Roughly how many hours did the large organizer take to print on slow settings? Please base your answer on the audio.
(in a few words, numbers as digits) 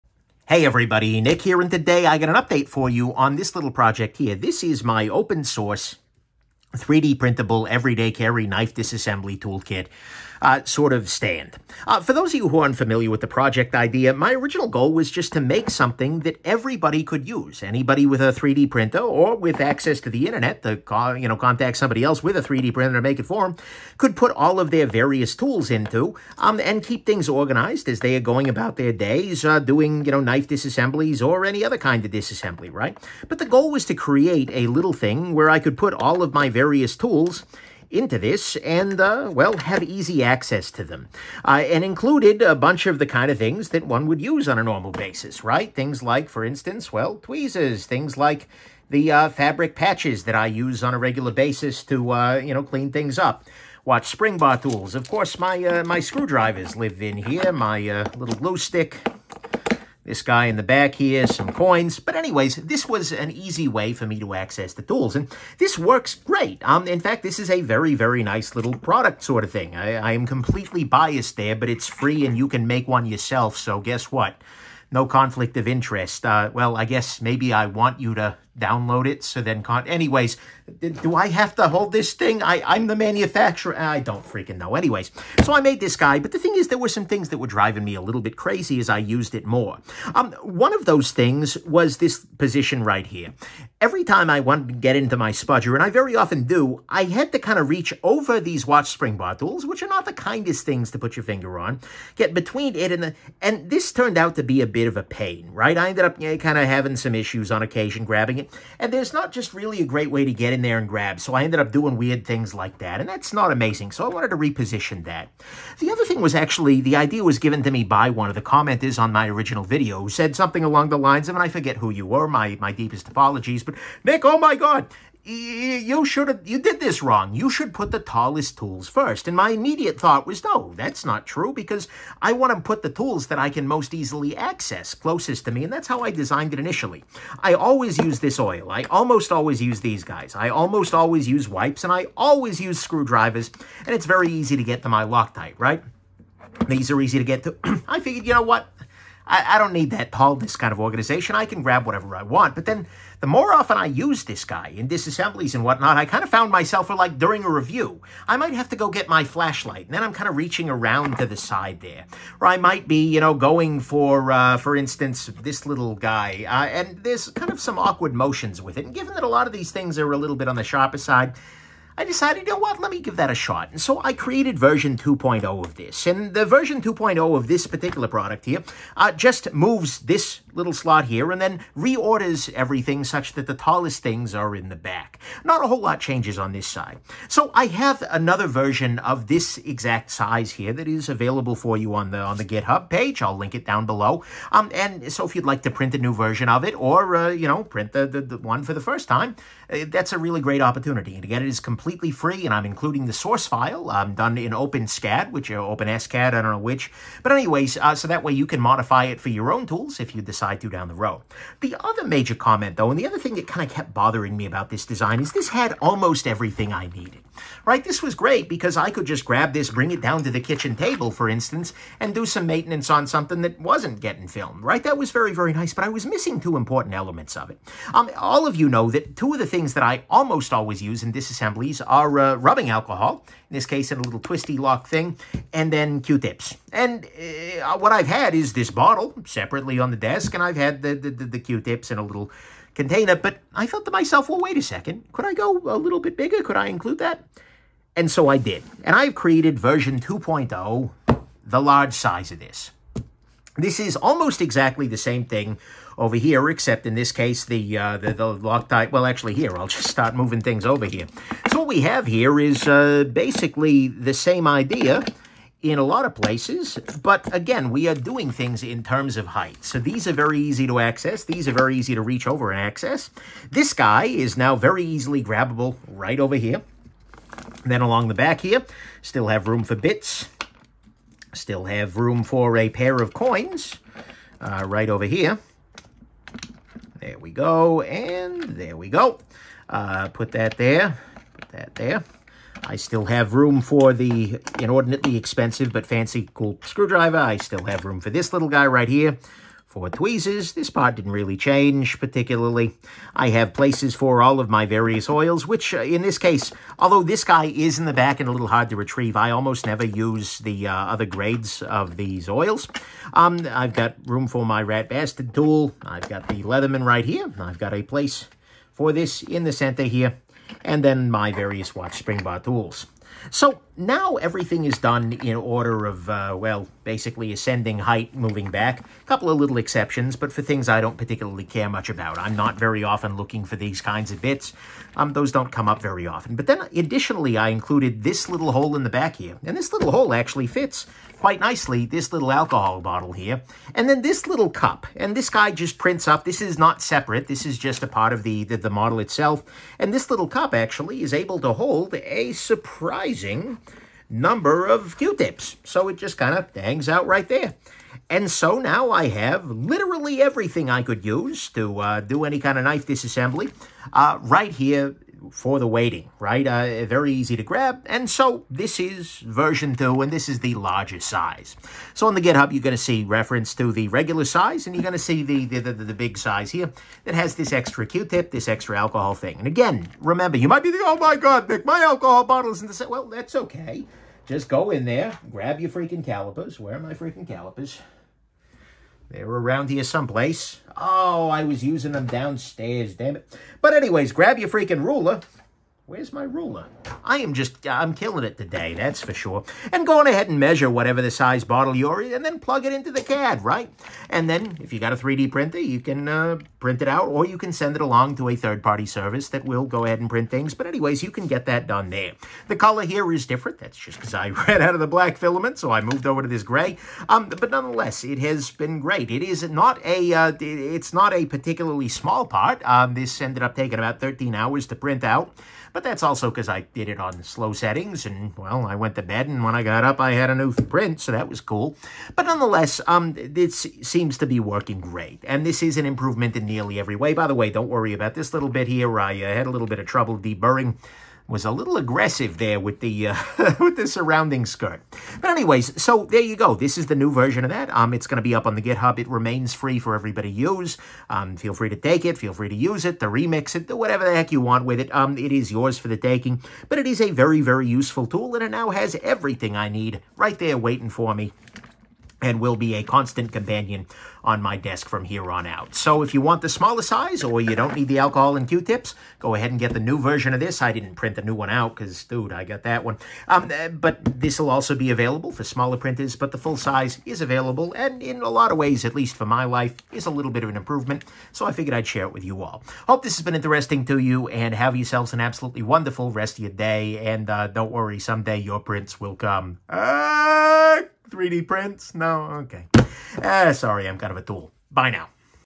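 13.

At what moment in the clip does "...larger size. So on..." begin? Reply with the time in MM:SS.
06:10.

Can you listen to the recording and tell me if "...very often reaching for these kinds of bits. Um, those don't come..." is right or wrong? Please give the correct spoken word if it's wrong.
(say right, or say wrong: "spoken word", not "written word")
wrong: "looking", not "reaching".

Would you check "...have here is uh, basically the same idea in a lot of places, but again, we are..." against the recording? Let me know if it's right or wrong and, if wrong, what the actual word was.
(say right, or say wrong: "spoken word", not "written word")
right.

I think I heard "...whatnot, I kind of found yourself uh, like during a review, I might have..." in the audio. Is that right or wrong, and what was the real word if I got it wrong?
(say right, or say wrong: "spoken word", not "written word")
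wrong: "myself", not "yourself".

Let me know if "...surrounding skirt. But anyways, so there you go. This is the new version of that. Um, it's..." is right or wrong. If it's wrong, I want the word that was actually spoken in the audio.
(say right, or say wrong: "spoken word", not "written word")
right.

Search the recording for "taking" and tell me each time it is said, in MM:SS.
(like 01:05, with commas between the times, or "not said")
07:03, 07:35.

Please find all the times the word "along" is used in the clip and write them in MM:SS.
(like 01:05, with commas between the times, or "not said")
02:00, 04:37, 06:47.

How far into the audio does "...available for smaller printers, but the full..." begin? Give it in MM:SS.
07:54.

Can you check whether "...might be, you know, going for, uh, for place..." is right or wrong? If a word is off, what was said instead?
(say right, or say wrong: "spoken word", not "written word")
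wrong: "instance", not "place".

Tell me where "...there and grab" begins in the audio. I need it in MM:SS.
01:50.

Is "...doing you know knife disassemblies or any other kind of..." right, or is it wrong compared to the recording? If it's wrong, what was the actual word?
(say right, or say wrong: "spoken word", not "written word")
right.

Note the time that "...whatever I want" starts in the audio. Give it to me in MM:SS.
02:31.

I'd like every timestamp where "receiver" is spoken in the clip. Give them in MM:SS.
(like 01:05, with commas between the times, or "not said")
not said.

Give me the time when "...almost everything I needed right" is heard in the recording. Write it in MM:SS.
03:35.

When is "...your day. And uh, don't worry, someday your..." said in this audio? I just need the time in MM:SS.
08:06.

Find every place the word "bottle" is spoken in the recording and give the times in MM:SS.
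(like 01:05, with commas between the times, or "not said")
03:58, 05:42, 06:22, 06:41.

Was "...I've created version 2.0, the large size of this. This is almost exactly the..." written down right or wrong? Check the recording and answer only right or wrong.
right.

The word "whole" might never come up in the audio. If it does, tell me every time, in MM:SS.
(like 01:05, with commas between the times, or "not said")
03:05.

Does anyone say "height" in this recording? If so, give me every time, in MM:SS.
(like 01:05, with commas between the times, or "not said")
04:29, 05:27.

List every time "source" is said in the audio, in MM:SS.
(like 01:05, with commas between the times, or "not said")
00:05, 03:23.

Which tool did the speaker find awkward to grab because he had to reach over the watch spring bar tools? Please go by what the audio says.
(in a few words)
spudger.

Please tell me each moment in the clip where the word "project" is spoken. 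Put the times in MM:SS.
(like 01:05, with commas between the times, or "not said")
00:03, 00:13.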